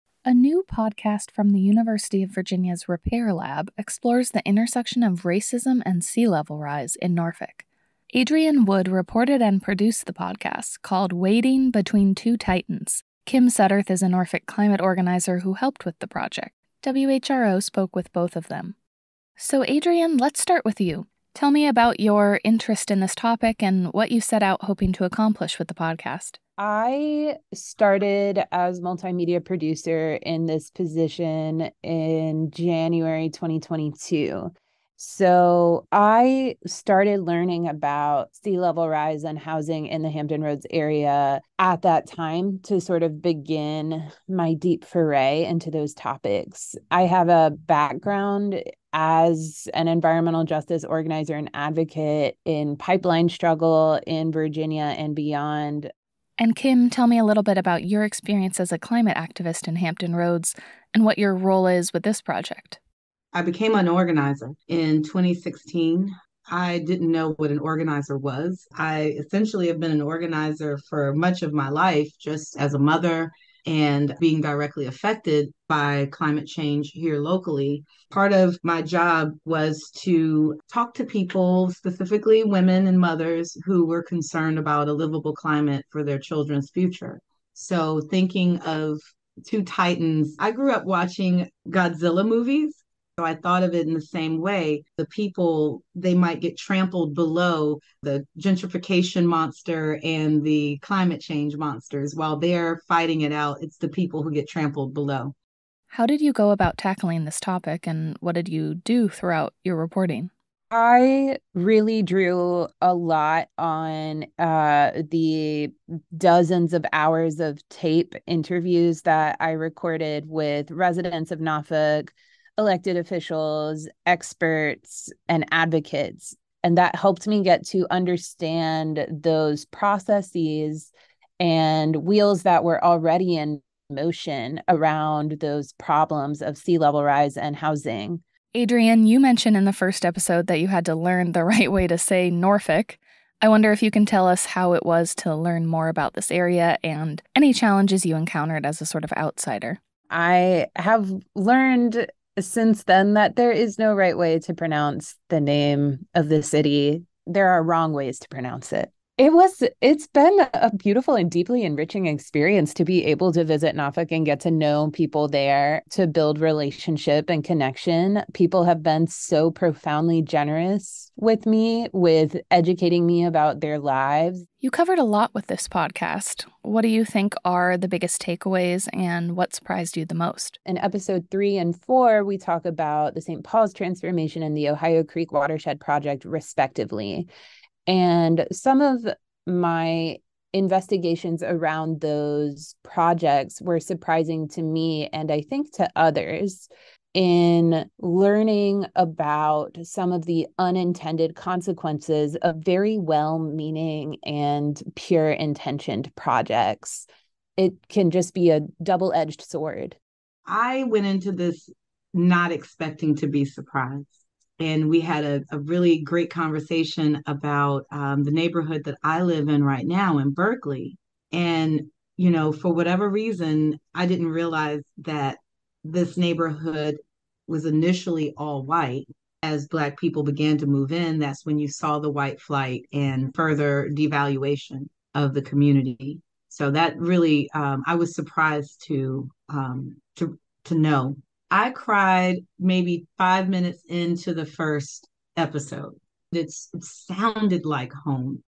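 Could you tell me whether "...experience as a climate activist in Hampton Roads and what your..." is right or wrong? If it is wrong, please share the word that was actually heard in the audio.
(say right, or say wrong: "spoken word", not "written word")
right.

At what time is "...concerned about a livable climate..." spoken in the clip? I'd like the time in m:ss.
1:24.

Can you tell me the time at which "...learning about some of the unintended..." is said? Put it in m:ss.
3:17.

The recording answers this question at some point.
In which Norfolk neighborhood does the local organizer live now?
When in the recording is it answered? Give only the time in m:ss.
3:40.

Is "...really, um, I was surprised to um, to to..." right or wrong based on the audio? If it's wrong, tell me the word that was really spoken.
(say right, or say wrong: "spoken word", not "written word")
right.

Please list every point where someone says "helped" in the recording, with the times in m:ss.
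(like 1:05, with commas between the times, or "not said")
0:15, 2:06.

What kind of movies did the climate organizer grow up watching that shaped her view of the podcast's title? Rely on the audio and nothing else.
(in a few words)
Godzilla movies.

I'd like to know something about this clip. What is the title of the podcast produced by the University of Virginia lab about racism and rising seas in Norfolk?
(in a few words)
Wading Between Two Titans.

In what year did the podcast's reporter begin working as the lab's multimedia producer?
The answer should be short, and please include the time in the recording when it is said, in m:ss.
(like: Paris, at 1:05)
2022, at 0:33.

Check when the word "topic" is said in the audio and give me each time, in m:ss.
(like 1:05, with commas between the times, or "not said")
0:23, 0:45, 1:47.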